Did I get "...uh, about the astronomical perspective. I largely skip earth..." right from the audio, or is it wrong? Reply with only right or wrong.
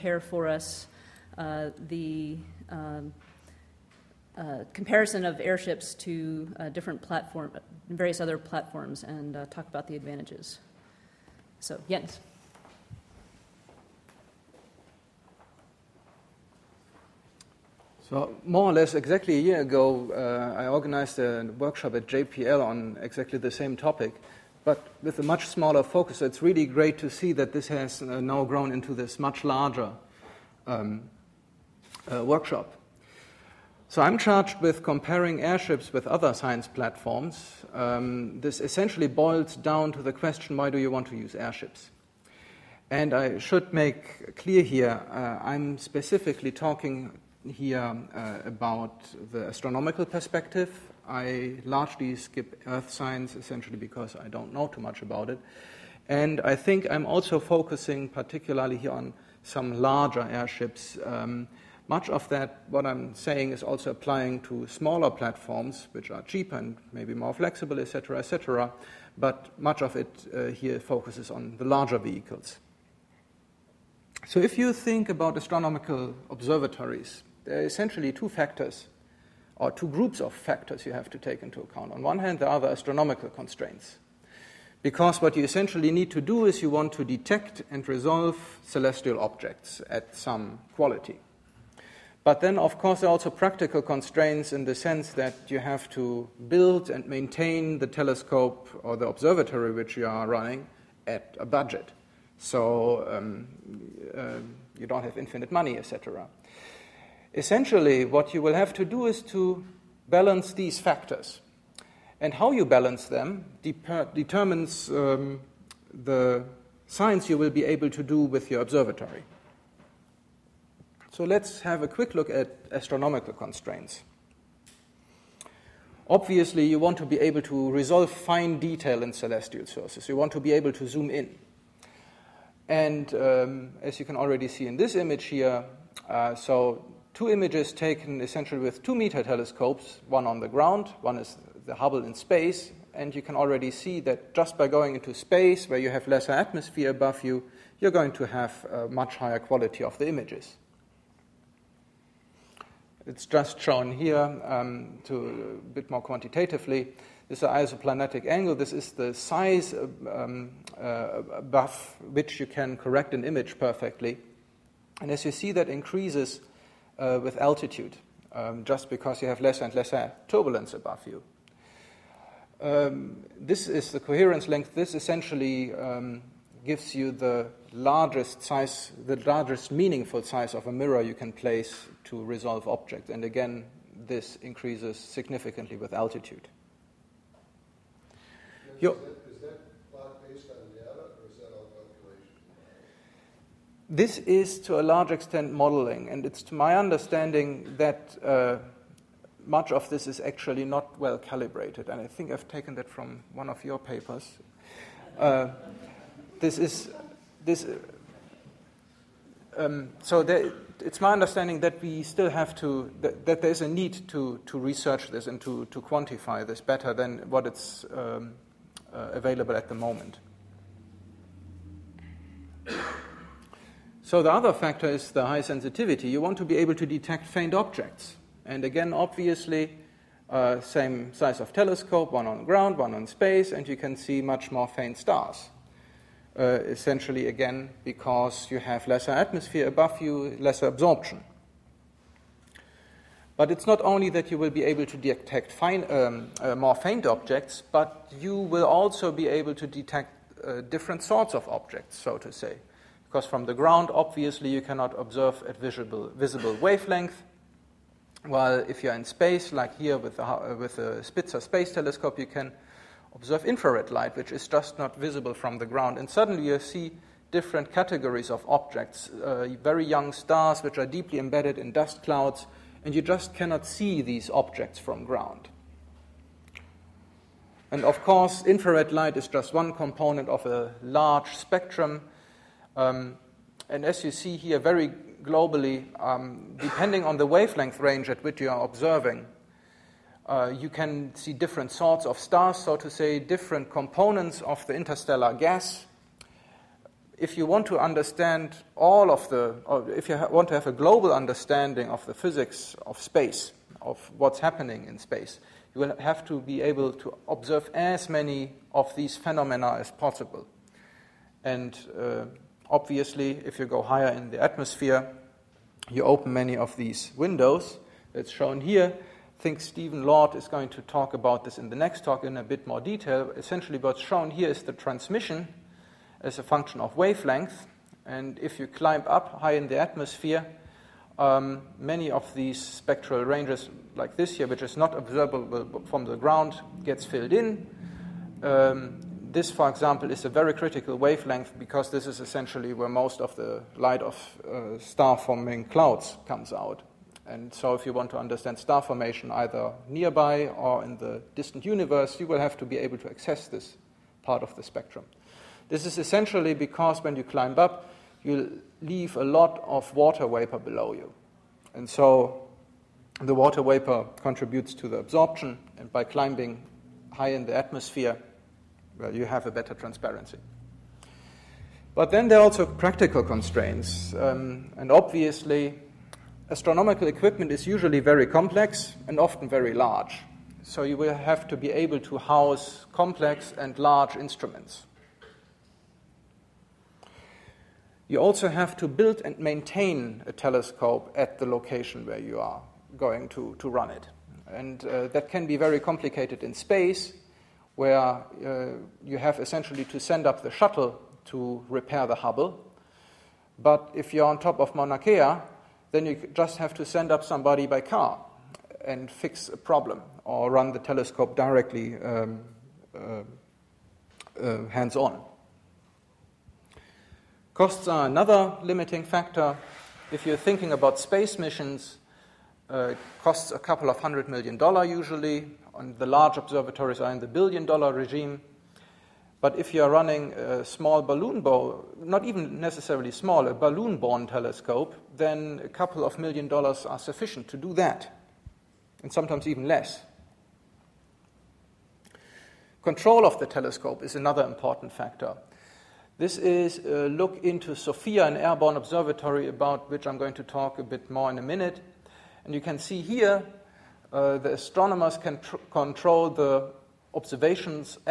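right.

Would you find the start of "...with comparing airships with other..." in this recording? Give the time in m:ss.
0:34.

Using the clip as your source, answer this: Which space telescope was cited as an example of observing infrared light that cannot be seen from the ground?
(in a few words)
Spitzer Space Telescope.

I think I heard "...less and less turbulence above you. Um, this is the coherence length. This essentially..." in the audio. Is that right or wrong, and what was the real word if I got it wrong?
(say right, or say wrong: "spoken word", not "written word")
right.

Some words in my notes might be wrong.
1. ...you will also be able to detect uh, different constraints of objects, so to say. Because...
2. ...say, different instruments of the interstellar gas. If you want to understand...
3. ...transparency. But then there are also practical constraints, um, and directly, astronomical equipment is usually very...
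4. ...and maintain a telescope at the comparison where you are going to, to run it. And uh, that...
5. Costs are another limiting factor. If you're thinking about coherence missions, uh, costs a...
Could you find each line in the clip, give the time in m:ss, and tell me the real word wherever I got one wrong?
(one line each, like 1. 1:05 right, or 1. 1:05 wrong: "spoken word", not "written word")
1. 4:08 wrong: "sorts", not "constraints"
2. 4:52 wrong: "components", not "instruments"
3. 6:09 wrong: "obviously", not "directly"
4. 6:29 wrong: "location", not "comparison"
5. 6:57 wrong: "space", not "coherence".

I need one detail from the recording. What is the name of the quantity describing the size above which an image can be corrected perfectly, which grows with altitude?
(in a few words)
isoplanatic angle.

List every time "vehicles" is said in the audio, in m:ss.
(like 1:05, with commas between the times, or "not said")
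1:11.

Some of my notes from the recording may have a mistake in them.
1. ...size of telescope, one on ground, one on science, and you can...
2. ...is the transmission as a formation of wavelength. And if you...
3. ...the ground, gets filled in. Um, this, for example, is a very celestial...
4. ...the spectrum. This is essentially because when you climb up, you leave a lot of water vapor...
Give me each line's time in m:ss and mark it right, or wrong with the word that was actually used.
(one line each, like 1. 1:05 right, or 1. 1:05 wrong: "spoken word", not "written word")
1. 3:51 wrong: "space", not "science"
2. 5:24 wrong: "function", not "formation"
3. 5:36 wrong: "critical", not "celestial"
4. 5:54 right.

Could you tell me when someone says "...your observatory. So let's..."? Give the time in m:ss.
1:58.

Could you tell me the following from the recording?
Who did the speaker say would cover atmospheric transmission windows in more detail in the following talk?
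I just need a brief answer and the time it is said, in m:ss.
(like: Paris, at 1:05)
Stephen Lord, at 5:19.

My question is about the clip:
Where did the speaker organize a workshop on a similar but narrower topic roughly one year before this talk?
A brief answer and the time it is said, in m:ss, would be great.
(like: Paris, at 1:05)
JPL, at 0:22.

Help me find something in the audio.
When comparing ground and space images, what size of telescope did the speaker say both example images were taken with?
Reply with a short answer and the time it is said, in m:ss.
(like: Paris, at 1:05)
2 meter, at 2:18.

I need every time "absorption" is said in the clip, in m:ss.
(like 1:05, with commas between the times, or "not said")
4:00, 6:04.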